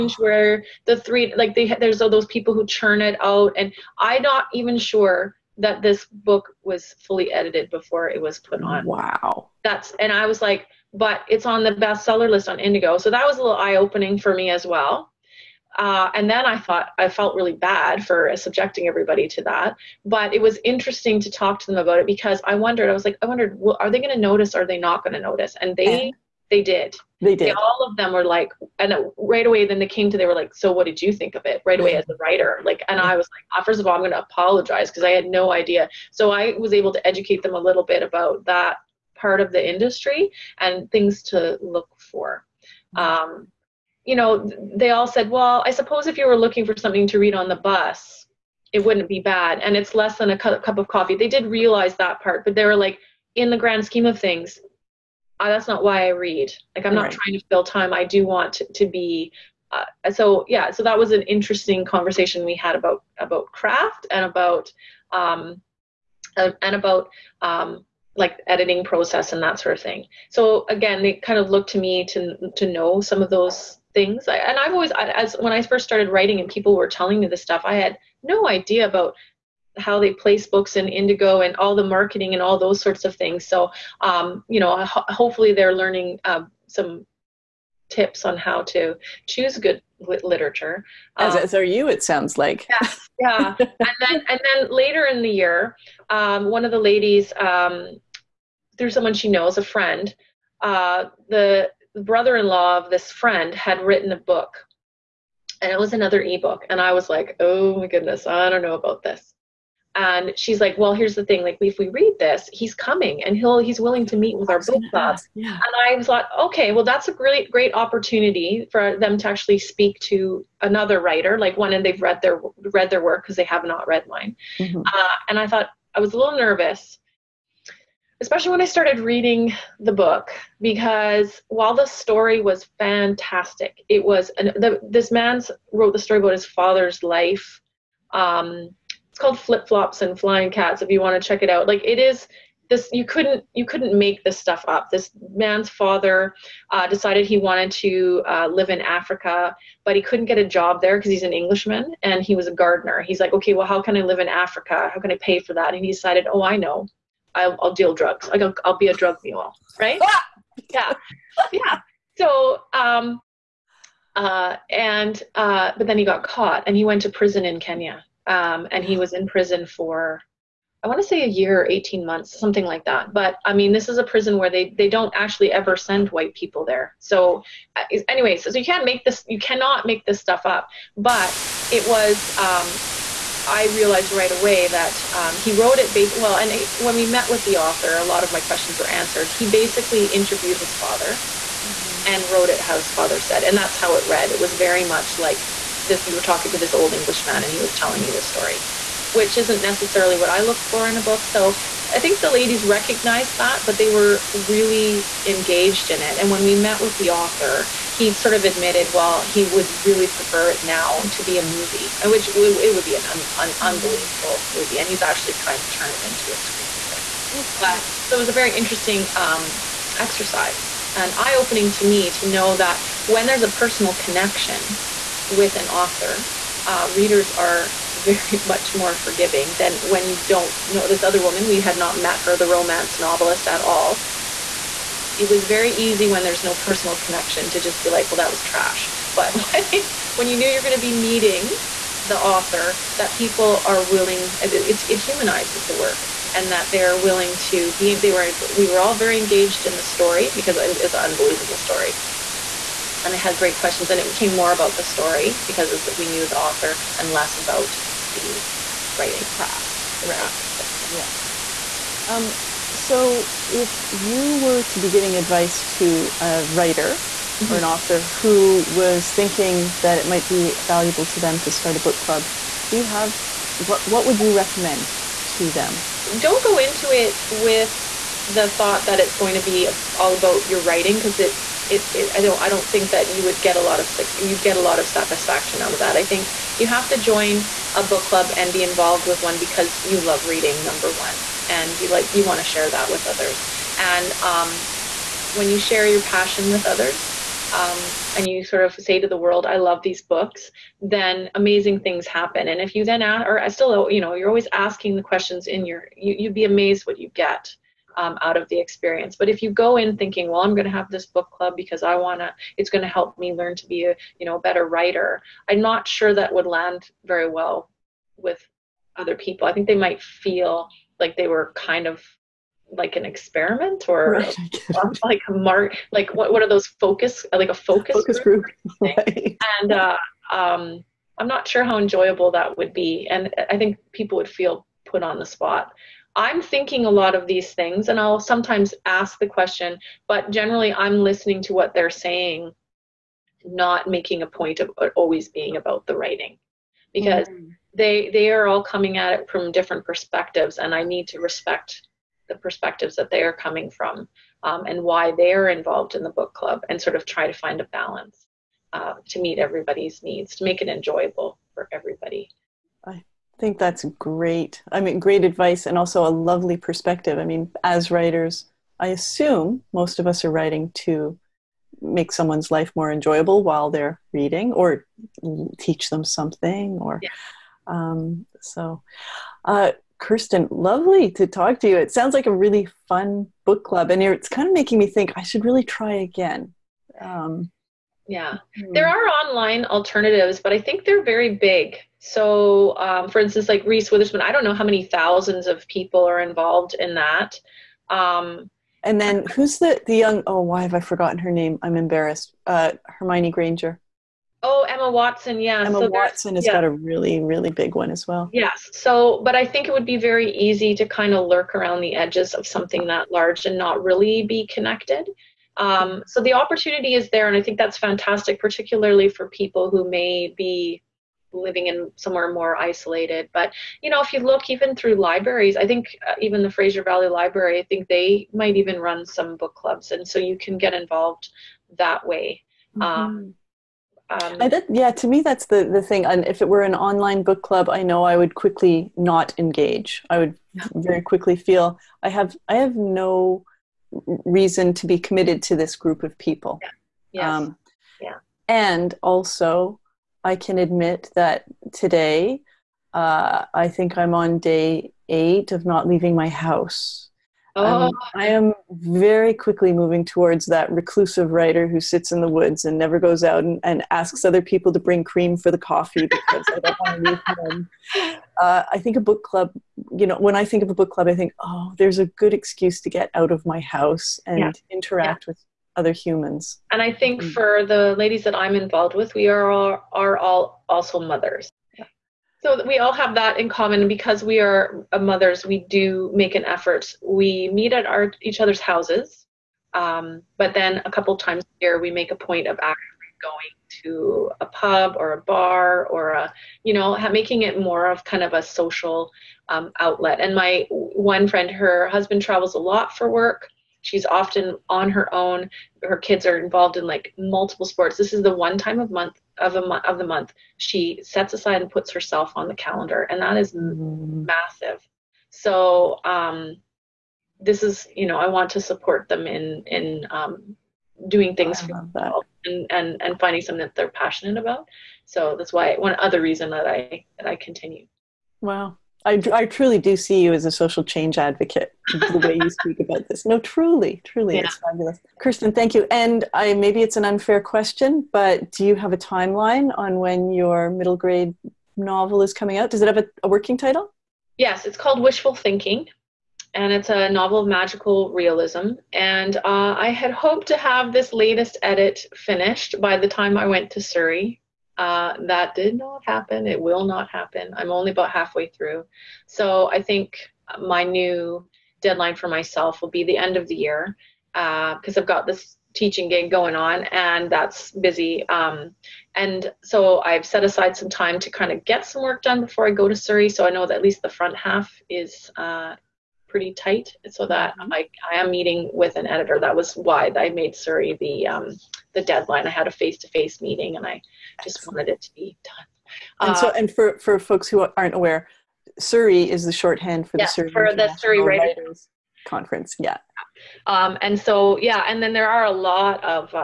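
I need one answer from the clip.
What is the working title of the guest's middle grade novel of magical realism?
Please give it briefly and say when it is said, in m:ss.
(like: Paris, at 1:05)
Wishful Thinking, at 9:05.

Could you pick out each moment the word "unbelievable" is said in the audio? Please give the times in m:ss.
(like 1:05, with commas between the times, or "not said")
3:33, 4:10.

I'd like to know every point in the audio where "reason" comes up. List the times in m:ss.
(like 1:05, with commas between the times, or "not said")
7:24, 8:46.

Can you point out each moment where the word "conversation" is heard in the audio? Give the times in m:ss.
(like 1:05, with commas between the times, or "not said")
1:01.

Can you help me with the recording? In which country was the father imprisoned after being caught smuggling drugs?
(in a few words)
Kenya.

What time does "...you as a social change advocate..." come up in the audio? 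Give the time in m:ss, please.
8:50.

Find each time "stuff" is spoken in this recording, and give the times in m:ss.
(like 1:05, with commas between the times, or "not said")
1:17, 2:24, 3:00.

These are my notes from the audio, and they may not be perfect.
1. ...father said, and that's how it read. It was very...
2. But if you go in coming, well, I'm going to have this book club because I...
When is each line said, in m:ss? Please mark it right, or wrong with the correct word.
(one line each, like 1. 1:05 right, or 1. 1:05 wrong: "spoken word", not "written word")
1. 3:12 right
2. 5:09 wrong: "thinking", not "coming".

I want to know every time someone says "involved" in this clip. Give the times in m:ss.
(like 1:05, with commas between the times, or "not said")
4:48, 5:55, 6:36, 7:10, 7:58, 8:26.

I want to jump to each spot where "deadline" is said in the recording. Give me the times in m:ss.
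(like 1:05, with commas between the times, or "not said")
9:21, 9:42.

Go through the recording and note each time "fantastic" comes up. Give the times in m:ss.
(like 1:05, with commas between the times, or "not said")
2:12, 6:57.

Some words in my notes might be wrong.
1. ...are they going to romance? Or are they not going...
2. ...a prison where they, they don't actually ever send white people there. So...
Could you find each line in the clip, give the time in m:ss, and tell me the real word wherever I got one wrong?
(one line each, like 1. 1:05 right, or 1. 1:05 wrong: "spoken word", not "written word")
1. 0:23 wrong: "notice", not "romance"
2. 2:53 right.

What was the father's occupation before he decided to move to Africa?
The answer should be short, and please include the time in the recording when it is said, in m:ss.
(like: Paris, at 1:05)
Gardener, at 2:32.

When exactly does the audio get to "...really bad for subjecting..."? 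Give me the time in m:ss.
0:17.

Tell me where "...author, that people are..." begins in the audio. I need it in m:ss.
4:02.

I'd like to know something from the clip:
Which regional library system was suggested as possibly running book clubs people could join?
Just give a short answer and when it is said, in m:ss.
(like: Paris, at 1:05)
Fraser Valley Library, at 7:06.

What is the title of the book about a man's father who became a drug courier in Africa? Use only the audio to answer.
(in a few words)
Flip Flops and Flying Cats.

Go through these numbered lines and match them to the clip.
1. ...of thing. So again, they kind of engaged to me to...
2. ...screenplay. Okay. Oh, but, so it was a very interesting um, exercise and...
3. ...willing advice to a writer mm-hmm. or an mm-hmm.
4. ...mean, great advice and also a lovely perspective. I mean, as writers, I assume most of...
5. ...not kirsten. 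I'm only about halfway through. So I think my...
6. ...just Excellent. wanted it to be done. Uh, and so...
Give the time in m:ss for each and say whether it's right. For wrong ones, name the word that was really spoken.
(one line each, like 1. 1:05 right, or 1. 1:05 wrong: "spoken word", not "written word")
1. 1:09 wrong: "looked", not "engaged"
2. 3:36 right
3. 4:24 wrong: "giving", not "willing"
4. 6:04 right
5. 9:16 wrong: "happen", not "kirsten"
6. 9:44 right.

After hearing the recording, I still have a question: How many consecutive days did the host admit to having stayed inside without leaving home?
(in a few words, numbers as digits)
8.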